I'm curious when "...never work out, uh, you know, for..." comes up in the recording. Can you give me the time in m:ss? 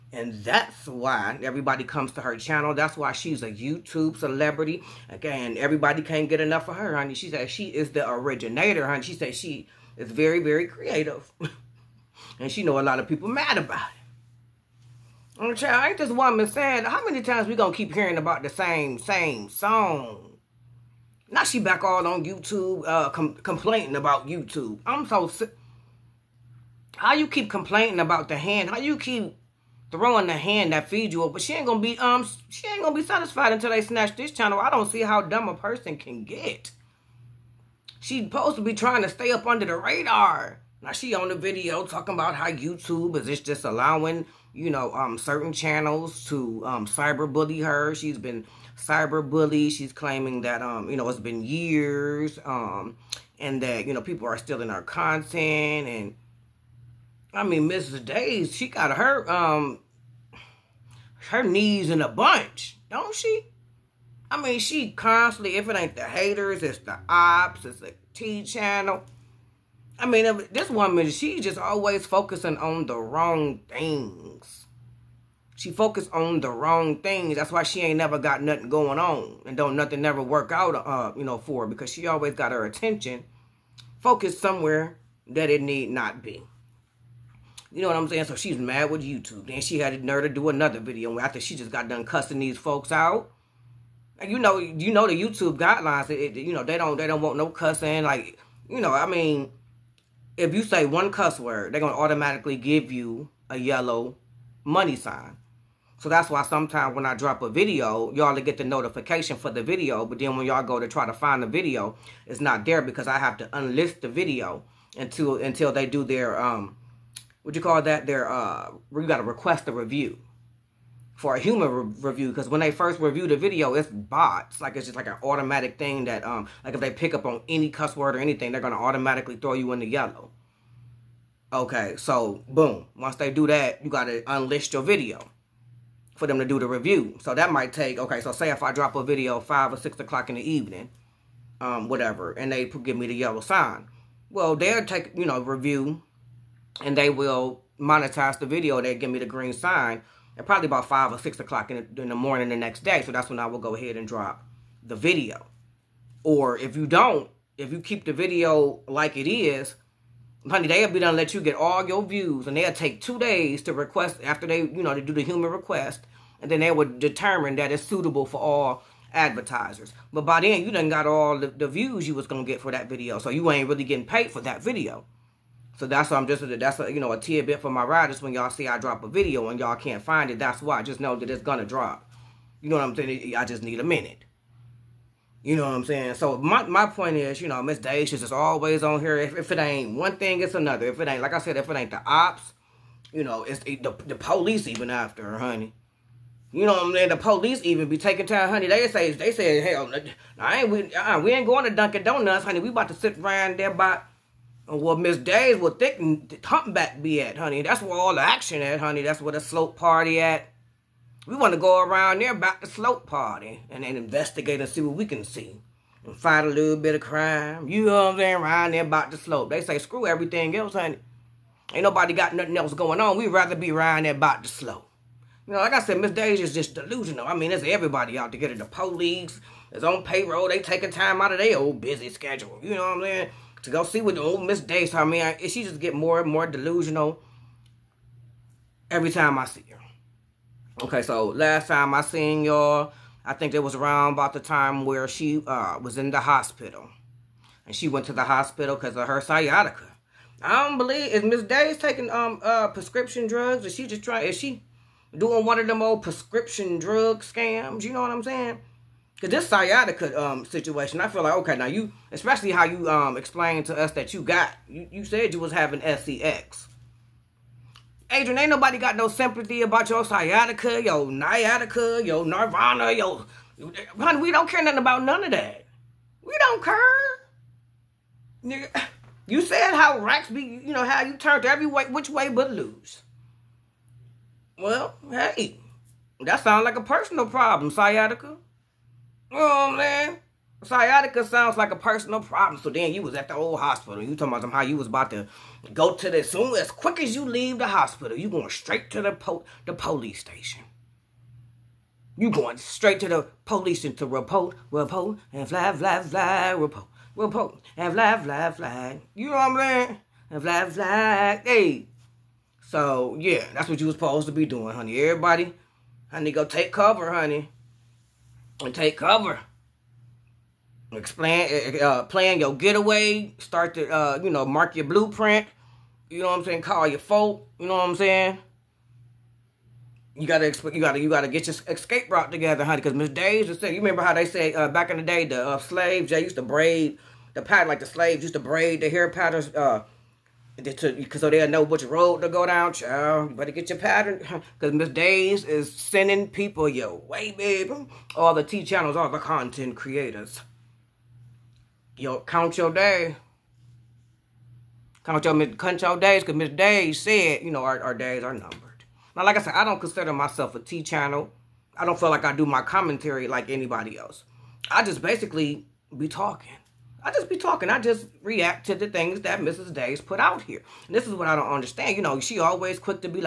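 1:20.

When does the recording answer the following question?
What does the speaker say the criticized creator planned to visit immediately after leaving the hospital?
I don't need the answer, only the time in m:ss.
4:59.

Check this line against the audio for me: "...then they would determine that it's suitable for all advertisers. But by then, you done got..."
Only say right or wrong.
right.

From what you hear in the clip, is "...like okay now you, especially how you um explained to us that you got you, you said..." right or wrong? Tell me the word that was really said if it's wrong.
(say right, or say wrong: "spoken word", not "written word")
right.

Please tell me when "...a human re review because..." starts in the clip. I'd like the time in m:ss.
2:01.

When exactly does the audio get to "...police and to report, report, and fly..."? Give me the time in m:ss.
5:03.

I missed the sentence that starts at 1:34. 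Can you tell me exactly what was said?
And you know, you know the YouTube guidelines.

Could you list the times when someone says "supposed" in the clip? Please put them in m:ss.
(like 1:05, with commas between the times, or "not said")
0:38, 5:13.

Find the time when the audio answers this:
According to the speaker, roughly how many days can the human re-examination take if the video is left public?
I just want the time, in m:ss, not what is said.
2:42.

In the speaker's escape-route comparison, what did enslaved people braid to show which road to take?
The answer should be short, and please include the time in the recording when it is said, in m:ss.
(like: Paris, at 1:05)
Hair patterns, at 5:38.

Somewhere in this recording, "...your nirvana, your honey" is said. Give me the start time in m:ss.
4:32.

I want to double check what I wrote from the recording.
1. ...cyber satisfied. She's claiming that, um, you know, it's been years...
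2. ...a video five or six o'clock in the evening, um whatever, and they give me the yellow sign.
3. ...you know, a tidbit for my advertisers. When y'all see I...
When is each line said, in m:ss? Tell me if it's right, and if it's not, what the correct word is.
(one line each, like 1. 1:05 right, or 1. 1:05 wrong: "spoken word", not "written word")
1. 0:48 wrong: "bullied", not "satisfied"
2. 2:18 right
3. 2:56 wrong: "riders", not "advertisers".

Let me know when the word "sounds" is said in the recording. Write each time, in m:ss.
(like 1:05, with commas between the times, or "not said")
4:46, 4:51.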